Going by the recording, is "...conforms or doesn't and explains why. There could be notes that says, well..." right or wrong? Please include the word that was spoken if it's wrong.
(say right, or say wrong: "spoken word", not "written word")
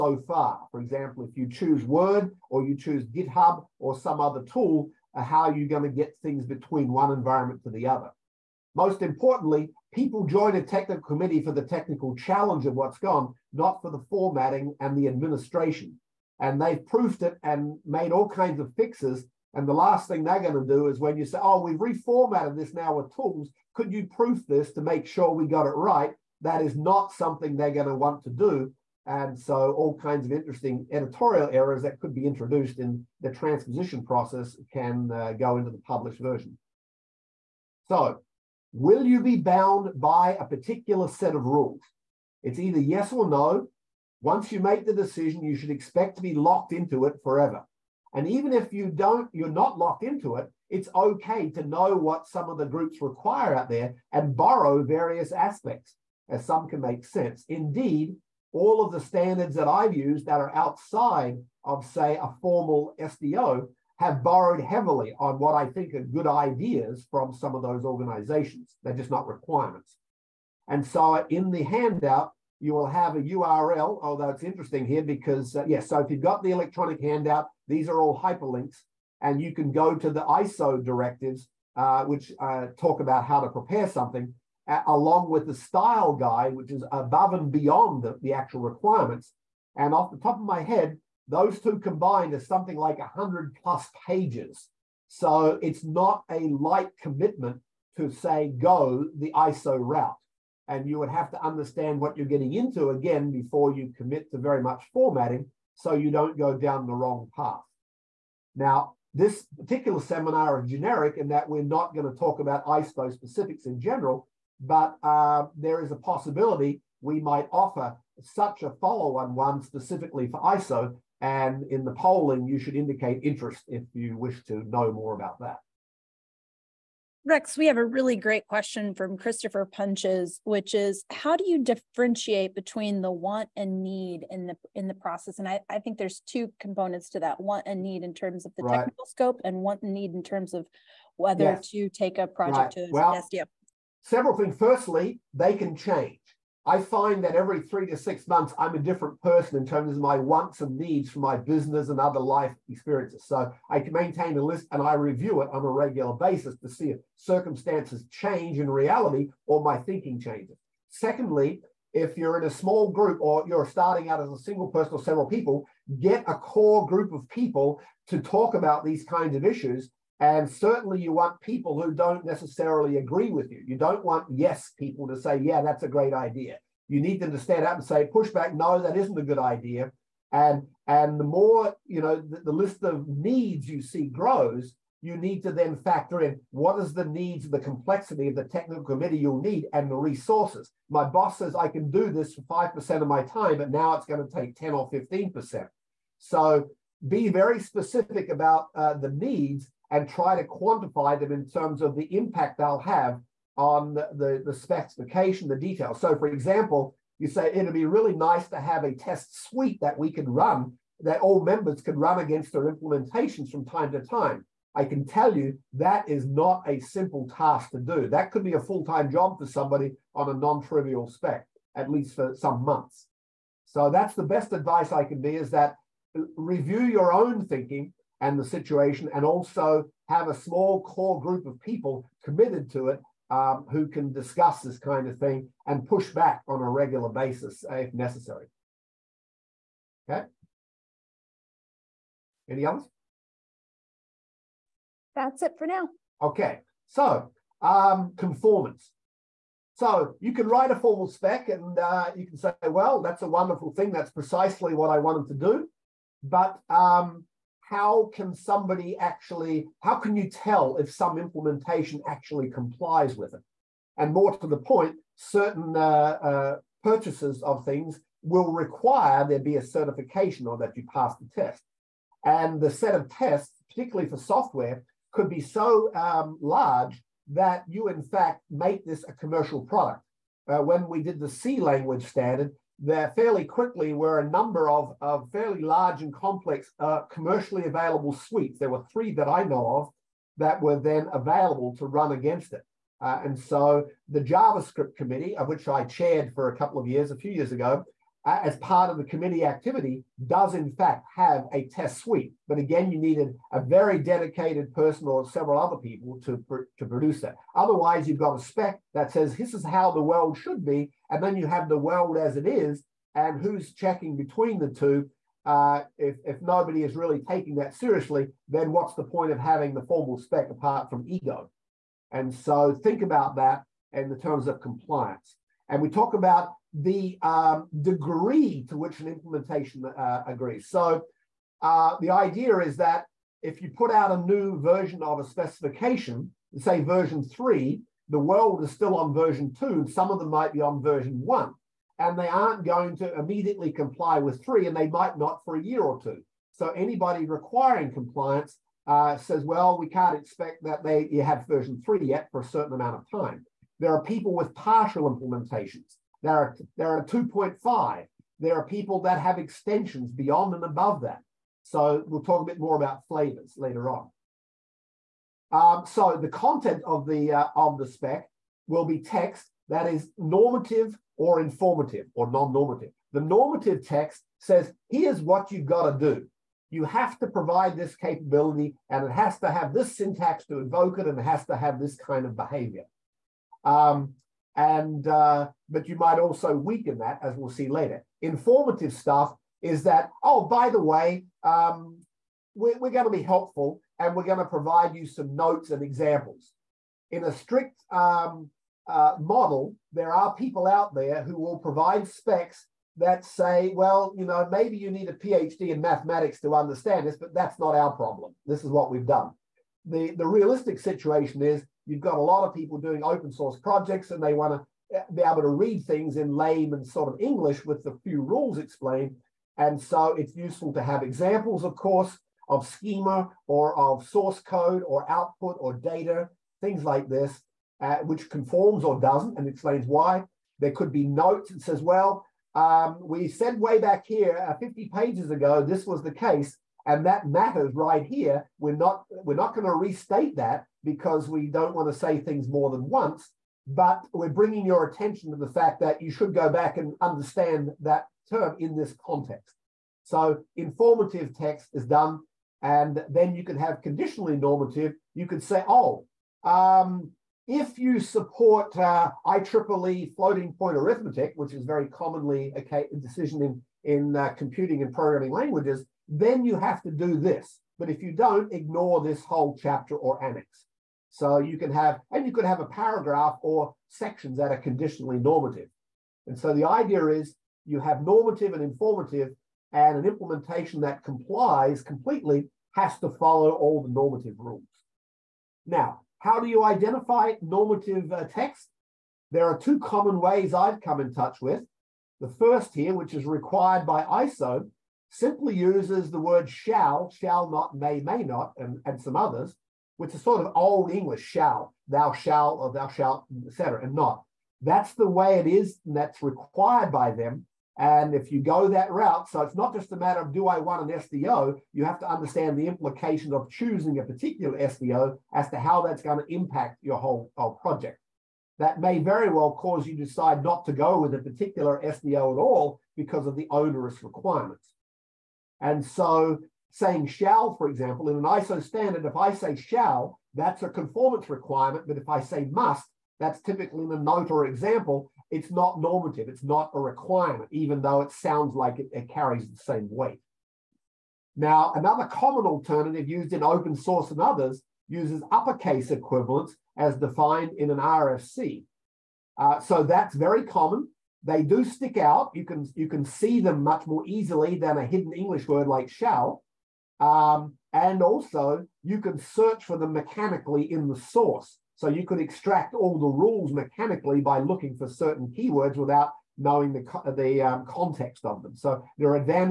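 right.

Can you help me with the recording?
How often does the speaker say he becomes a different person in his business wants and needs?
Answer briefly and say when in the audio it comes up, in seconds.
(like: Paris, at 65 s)
every three to six months, at 147 s.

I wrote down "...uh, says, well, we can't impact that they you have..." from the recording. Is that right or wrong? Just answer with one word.
wrong.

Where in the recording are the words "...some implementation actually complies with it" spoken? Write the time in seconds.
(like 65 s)
260 s.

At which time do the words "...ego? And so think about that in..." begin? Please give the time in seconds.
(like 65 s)
321 s.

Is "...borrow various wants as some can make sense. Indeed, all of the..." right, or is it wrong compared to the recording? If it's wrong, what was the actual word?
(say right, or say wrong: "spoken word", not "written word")
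wrong: "aspects", not "wants".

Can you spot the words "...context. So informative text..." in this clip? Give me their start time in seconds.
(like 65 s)
449 s.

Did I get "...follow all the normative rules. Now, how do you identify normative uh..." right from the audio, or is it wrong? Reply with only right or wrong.
right.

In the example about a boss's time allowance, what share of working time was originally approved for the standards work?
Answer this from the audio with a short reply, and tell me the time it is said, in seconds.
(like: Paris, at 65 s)
5%, at 192 s.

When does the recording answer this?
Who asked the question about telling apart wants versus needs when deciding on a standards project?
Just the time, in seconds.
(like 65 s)
129 s.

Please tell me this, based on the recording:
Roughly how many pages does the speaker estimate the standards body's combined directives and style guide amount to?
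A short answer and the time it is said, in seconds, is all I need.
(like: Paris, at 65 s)
100 plus pages, at 92 s.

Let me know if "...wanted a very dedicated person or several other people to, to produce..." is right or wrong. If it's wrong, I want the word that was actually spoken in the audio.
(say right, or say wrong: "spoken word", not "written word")
wrong: "needed", not "wanted".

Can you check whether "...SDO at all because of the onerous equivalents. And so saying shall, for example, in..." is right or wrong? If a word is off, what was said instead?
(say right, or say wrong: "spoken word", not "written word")
wrong: "requirements", not "equivalents".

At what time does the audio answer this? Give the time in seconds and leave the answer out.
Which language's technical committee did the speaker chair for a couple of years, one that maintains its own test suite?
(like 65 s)
294 s.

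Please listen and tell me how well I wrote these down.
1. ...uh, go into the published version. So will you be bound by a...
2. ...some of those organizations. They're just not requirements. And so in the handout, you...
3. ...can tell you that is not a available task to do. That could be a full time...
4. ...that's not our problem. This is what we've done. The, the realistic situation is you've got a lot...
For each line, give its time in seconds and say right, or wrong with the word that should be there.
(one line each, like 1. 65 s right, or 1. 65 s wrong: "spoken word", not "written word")
1. 35 s right
2. 67 s right
3. 214 s wrong: "simple", not "available"
4. 407 s right.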